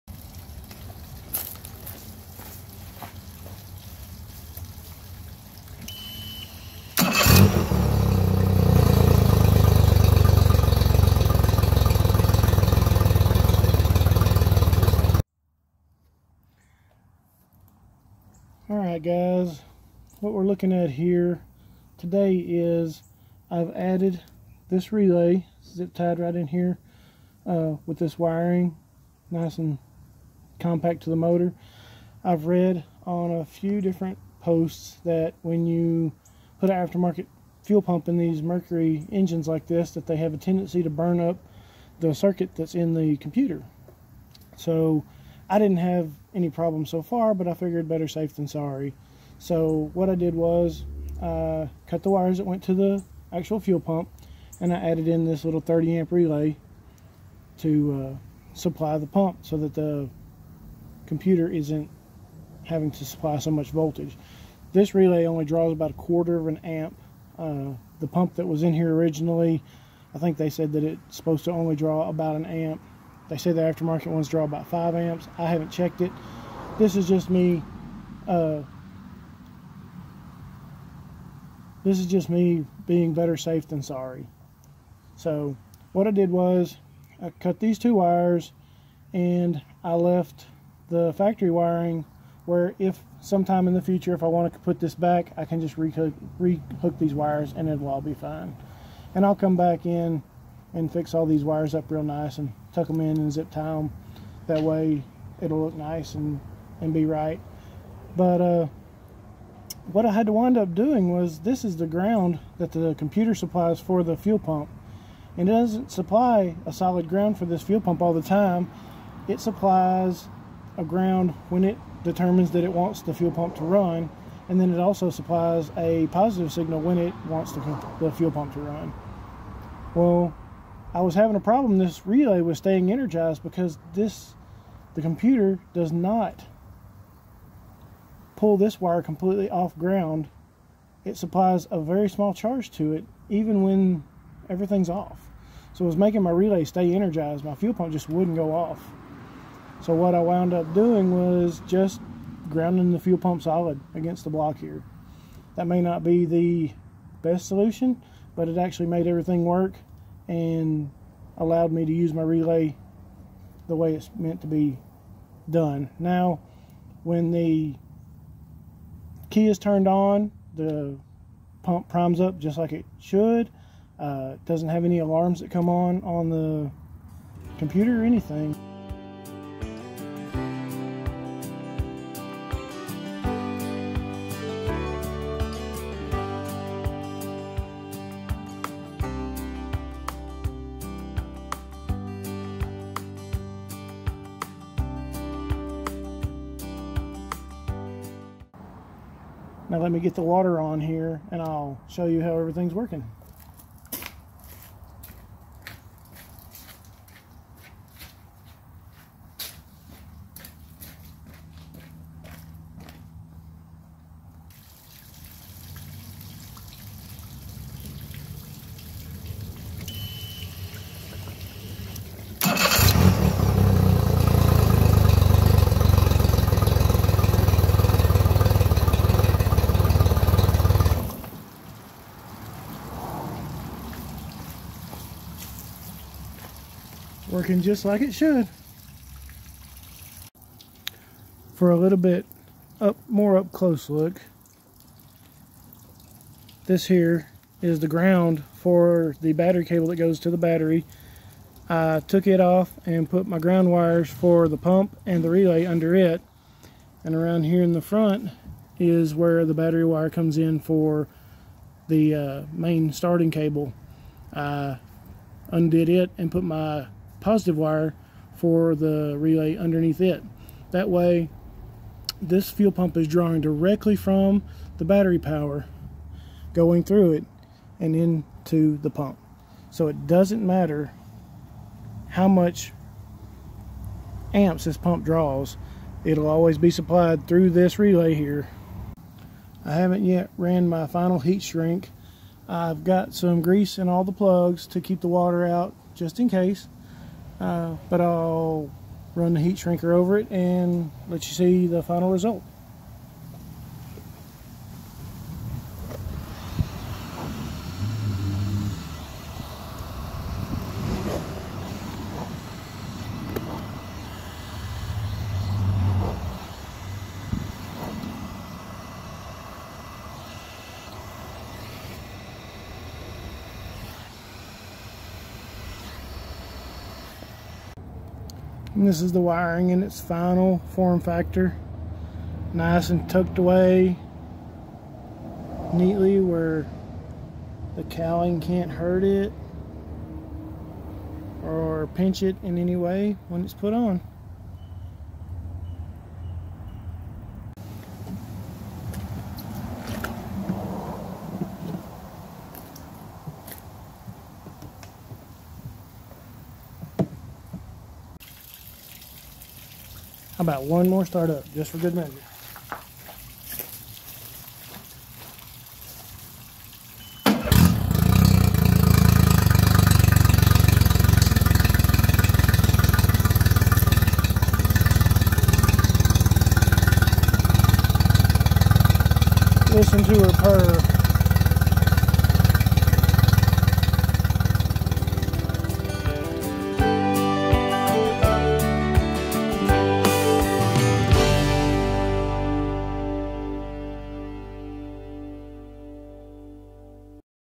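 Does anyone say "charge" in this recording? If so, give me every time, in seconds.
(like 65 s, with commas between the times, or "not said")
142 s.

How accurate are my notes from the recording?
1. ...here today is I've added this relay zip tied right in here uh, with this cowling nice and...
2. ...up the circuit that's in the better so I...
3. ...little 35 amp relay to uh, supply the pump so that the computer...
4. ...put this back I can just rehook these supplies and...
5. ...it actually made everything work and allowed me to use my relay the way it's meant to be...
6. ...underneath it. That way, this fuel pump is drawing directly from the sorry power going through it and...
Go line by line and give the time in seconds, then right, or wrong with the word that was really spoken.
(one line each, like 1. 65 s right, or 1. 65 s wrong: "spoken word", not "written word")
1. 20 s wrong: "wiring", not "cowling"
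2. 41 s wrong: "computer", not "better"
3. 55 s wrong: "30", not "35"
4. 94 s wrong: "wires", not "supplies"
5. 158 s right
6. 269 s wrong: "battery", not "sorry".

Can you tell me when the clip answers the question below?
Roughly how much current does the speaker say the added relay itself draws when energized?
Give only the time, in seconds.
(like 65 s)
65 s.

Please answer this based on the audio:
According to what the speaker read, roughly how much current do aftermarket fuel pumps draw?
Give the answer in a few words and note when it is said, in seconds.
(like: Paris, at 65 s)
5 amps, at 74 s.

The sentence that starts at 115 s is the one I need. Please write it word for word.
And it doesn't supply a solid ground for this fuel pump all the time.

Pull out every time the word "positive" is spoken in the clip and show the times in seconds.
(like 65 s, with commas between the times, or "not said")
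126 s, 267 s.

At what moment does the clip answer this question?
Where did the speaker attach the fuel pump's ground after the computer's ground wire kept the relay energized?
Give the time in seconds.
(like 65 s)
154 s.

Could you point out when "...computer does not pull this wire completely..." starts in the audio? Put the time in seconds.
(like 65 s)
135 s.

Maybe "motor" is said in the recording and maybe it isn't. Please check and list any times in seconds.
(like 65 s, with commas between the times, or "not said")
31 s.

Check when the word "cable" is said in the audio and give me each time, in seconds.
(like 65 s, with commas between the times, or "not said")
249 s, 263 s.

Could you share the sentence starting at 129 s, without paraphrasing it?
Well, I was having a problem.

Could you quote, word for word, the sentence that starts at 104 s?
That way it'll look nice and, and be right.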